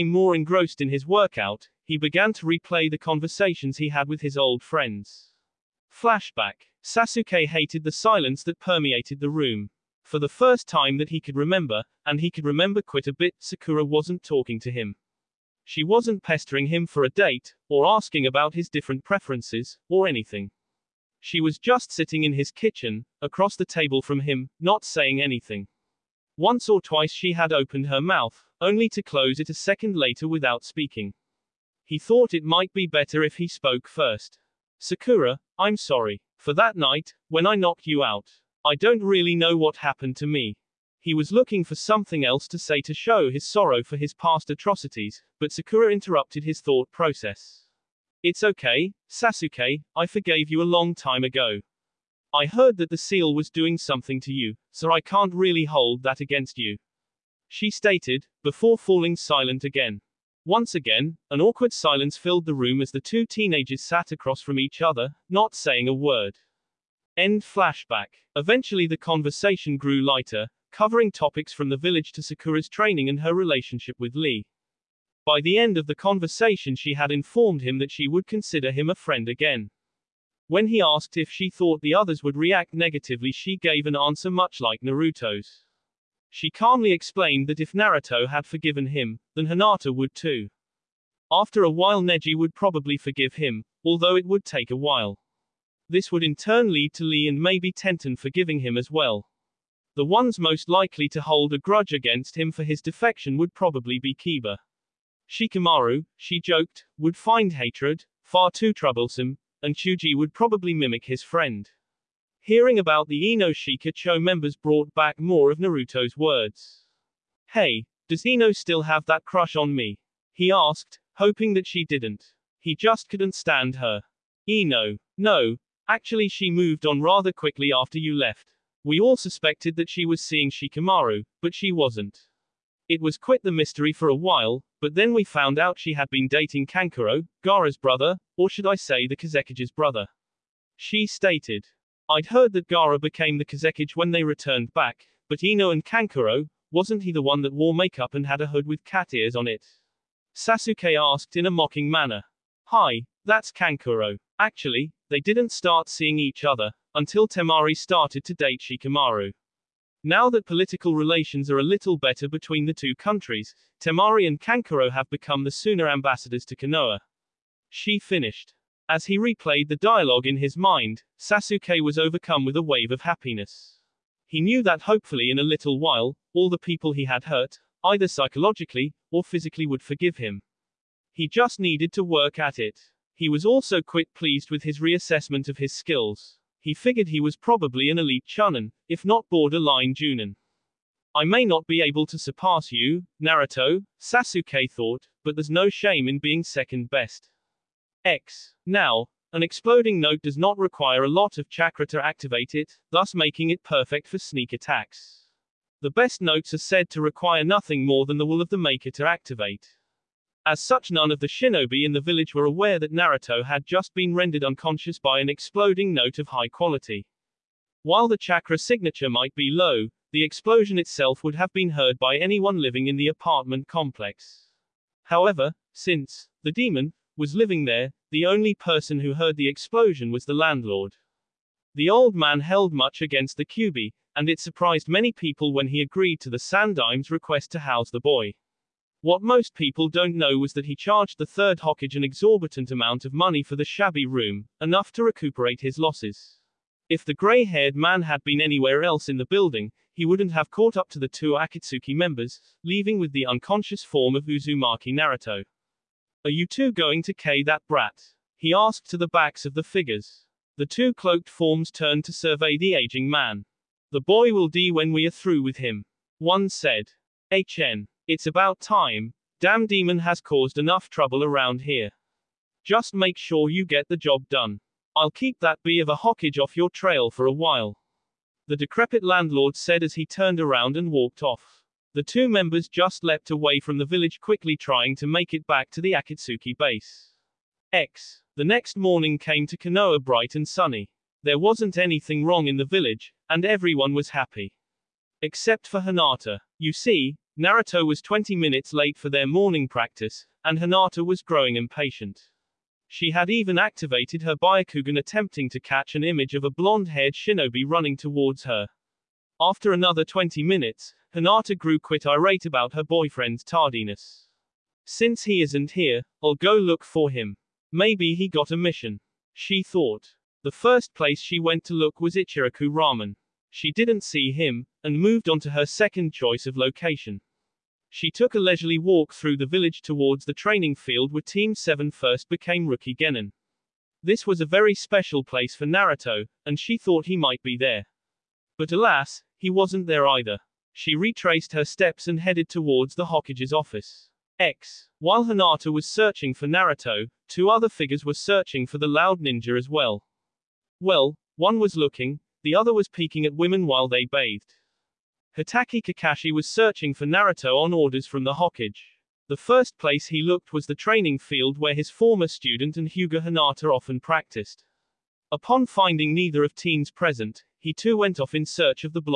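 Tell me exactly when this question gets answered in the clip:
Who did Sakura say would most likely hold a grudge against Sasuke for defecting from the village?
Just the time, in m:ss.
1:44.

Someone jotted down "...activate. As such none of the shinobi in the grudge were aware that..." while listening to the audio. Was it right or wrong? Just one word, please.
wrong.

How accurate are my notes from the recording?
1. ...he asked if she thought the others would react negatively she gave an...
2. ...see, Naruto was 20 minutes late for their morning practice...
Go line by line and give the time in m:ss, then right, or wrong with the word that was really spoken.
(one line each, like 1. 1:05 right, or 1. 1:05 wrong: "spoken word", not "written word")
1. 1:20 right
2. 4:56 right.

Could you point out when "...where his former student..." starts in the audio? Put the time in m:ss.
6:01.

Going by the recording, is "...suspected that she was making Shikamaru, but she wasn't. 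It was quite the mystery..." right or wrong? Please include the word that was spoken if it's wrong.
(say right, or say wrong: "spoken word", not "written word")
wrong: "seeing", not "making".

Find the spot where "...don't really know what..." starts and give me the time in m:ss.
0:38.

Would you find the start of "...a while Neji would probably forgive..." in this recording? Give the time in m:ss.
1:31.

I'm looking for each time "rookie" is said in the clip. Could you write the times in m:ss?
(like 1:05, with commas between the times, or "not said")
5:32.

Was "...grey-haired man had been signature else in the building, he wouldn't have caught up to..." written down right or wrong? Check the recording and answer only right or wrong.
wrong.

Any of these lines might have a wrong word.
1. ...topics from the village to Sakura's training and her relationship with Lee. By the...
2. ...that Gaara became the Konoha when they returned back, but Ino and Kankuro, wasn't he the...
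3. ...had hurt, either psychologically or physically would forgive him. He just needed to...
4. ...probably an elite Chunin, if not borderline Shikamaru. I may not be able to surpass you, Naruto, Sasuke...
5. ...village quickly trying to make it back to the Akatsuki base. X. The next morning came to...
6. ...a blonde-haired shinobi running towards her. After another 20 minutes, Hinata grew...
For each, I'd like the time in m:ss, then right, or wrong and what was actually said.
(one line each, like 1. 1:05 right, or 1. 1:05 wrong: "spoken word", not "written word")
1. 1:11 right
2. 2:22 wrong: "Kazekage", not "Konoha"
3. 2:57 right
4. 3:07 wrong: "Junin", not "Shikamaru"
5. 4:43 right
6. 5:06 right.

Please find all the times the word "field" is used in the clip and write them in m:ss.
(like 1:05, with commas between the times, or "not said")
5:30, 6:01.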